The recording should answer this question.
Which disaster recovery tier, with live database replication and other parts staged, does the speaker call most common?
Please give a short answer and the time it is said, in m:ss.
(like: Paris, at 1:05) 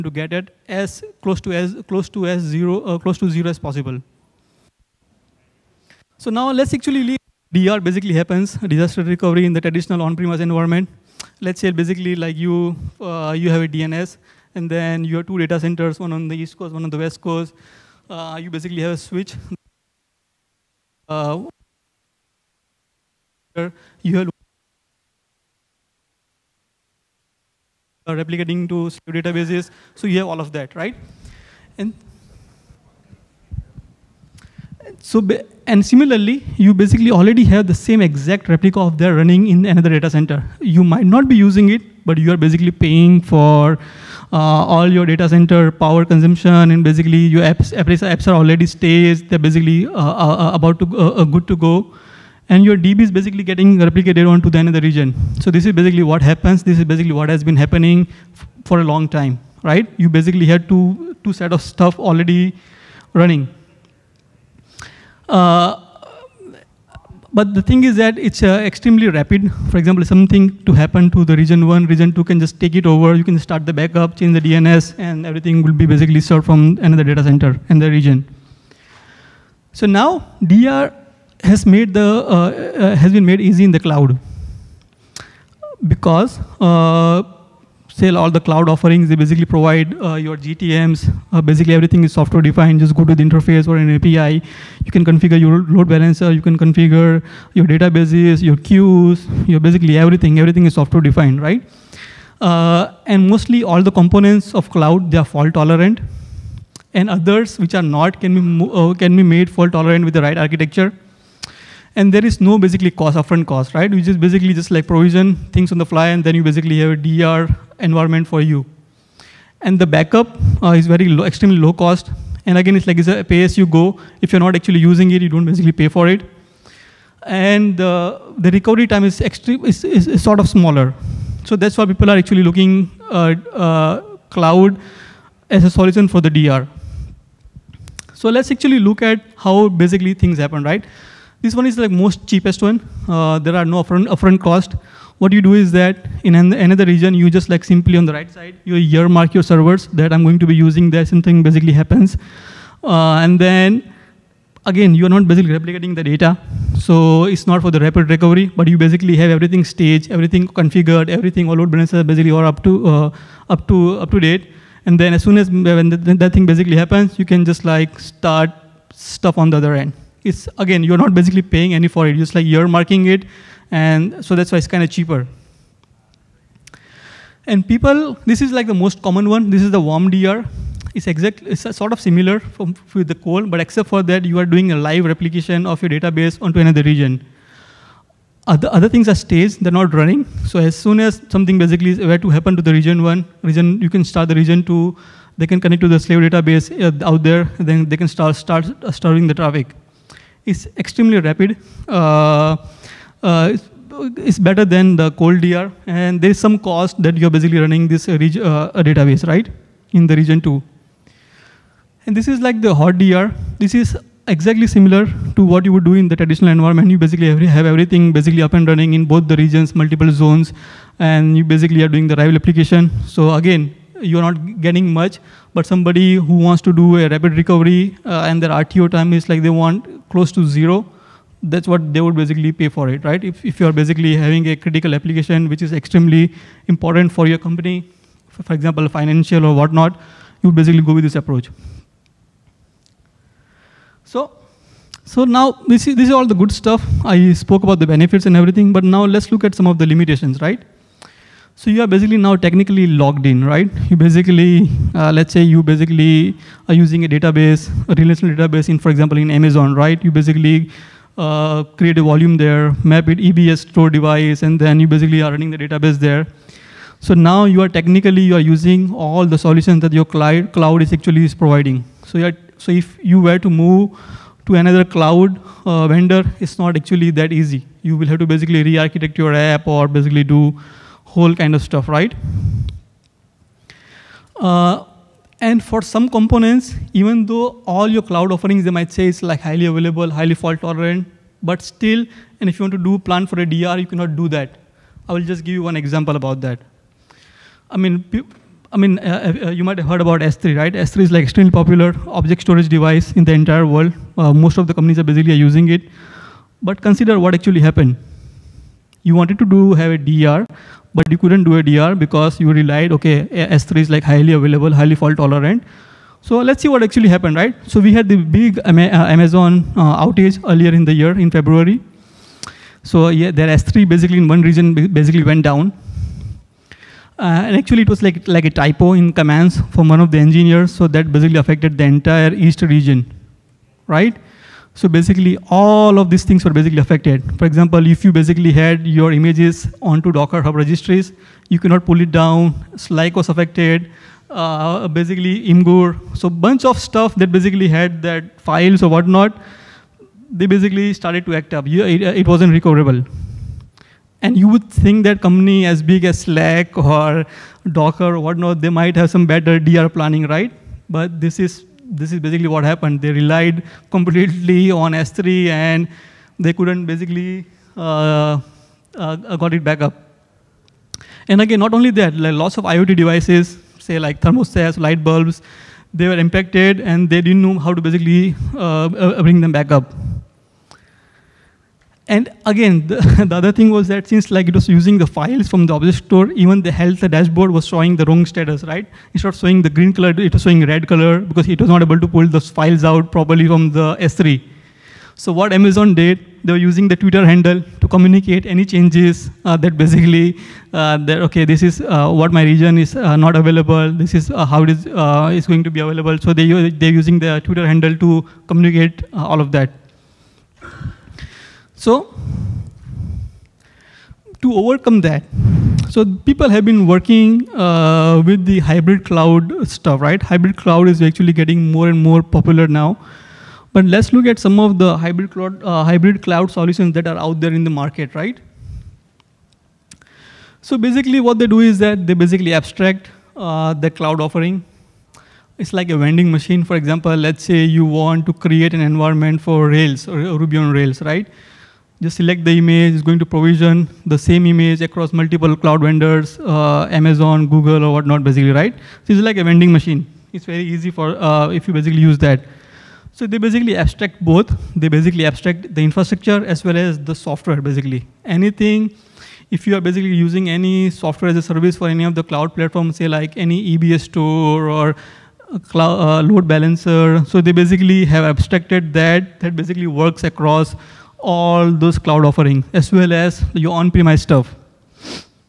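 Warm DR, at 2:59.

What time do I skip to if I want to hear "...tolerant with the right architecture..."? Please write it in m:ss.
1:49.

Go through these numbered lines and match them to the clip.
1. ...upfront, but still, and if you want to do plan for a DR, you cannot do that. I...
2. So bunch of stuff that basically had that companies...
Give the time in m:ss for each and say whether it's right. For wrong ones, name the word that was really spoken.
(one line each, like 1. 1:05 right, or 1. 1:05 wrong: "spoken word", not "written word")
1. 4:50 wrong: "tolerant", not "upfront"
2. 5:46 wrong: "files", not "companies".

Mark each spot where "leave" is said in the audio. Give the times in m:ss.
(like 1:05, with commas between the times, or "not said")
0:07.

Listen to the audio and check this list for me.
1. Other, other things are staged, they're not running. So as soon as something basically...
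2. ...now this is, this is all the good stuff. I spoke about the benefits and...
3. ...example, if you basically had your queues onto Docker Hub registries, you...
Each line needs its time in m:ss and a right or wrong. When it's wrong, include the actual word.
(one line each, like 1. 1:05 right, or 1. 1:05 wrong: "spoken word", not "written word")
1. 3:08 right
2. 4:05 right
3. 5:37 wrong: "images", not "queues".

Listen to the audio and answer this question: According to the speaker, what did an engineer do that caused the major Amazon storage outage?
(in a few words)
A typo in commands.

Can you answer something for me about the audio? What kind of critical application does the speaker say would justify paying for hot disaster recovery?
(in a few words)
Financial.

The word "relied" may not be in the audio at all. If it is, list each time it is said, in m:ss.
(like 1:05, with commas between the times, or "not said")
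5:12, 6:03.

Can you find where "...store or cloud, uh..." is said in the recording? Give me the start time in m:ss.
7:44.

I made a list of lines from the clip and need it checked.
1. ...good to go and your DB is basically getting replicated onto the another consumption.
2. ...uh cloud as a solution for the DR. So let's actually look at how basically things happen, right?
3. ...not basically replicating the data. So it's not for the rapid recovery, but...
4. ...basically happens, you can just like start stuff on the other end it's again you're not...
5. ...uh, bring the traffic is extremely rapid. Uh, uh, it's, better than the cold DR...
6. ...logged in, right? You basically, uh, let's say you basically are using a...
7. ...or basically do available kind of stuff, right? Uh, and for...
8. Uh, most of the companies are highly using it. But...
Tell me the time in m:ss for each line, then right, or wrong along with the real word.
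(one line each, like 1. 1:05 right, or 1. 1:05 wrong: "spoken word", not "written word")
1. 0:51 wrong: "region", not "consumption"
2. 2:13 right
3. 2:35 right
4. 2:46 right
5. 3:18 wrong: "starving", not "bring"
6. 4:12 right
7. 4:39 wrong: "whole", not "available"
8. 5:04 wrong: "basically", not "highly".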